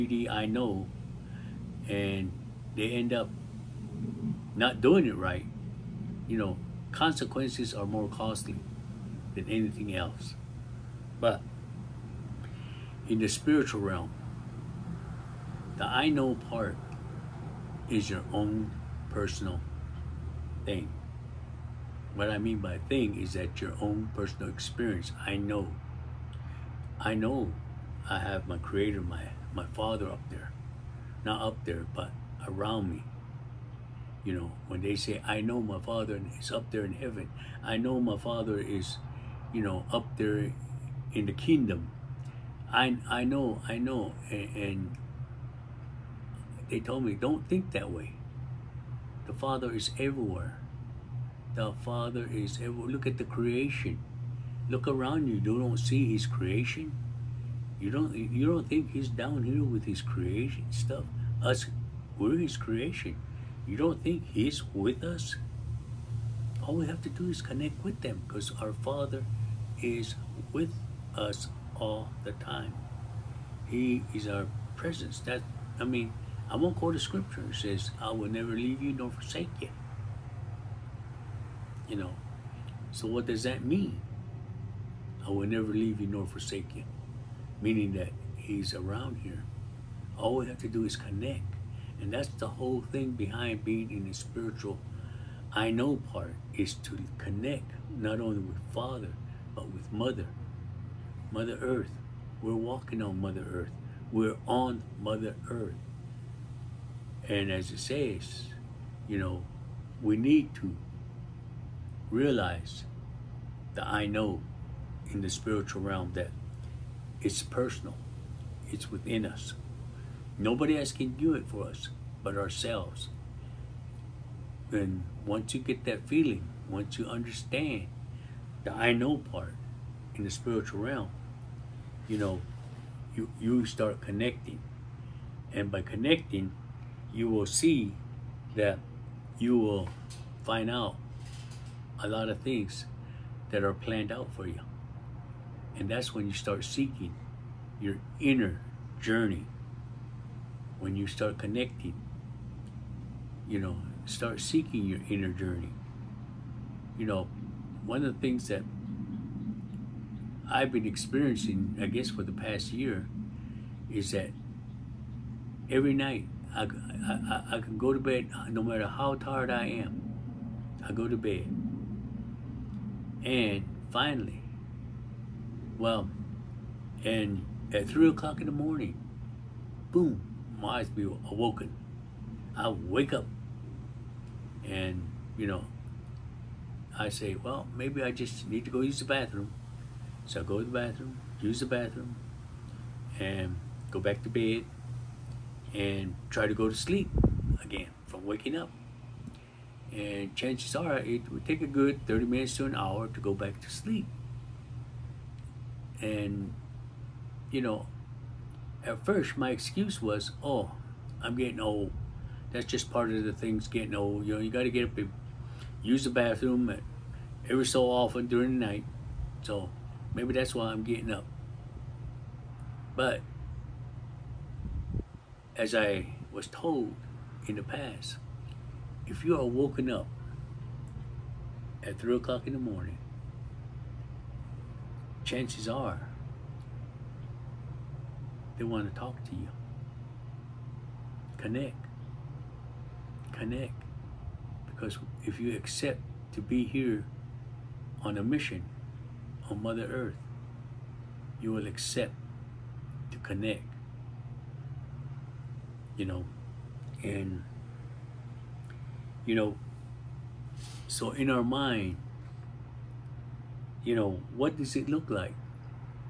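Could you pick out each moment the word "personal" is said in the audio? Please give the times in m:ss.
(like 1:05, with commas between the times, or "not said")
0:19, 0:24, 1:57.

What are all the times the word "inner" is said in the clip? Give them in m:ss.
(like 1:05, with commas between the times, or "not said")
2:28, 2:35.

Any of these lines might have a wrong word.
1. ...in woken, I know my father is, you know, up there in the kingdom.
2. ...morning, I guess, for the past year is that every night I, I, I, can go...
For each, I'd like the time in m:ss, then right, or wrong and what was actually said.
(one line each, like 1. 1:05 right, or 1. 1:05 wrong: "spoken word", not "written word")
1. 0:36 wrong: "heaven", not "woken"
2. 2:40 wrong: "experiencing", not "morning".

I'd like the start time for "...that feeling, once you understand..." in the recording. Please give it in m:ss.
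2:05.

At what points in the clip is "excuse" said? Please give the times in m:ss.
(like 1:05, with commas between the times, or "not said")
3:29.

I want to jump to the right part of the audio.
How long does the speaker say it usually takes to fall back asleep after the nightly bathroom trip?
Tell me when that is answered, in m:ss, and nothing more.
3:22.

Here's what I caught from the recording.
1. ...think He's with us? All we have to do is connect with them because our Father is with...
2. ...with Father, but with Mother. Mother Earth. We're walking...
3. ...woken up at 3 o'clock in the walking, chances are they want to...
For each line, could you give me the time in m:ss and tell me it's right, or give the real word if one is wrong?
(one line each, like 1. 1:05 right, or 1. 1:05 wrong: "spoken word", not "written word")
1. 1:04 right
2. 1:38 right
3. 3:49 wrong: "morning", not "walking".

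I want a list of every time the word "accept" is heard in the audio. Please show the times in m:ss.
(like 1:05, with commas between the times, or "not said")
4:05, 4:11.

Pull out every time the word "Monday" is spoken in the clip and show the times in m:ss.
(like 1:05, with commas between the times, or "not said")
not said.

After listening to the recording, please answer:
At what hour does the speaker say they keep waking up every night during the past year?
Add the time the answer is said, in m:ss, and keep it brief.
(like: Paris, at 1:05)
3 o'clock, at 2:57.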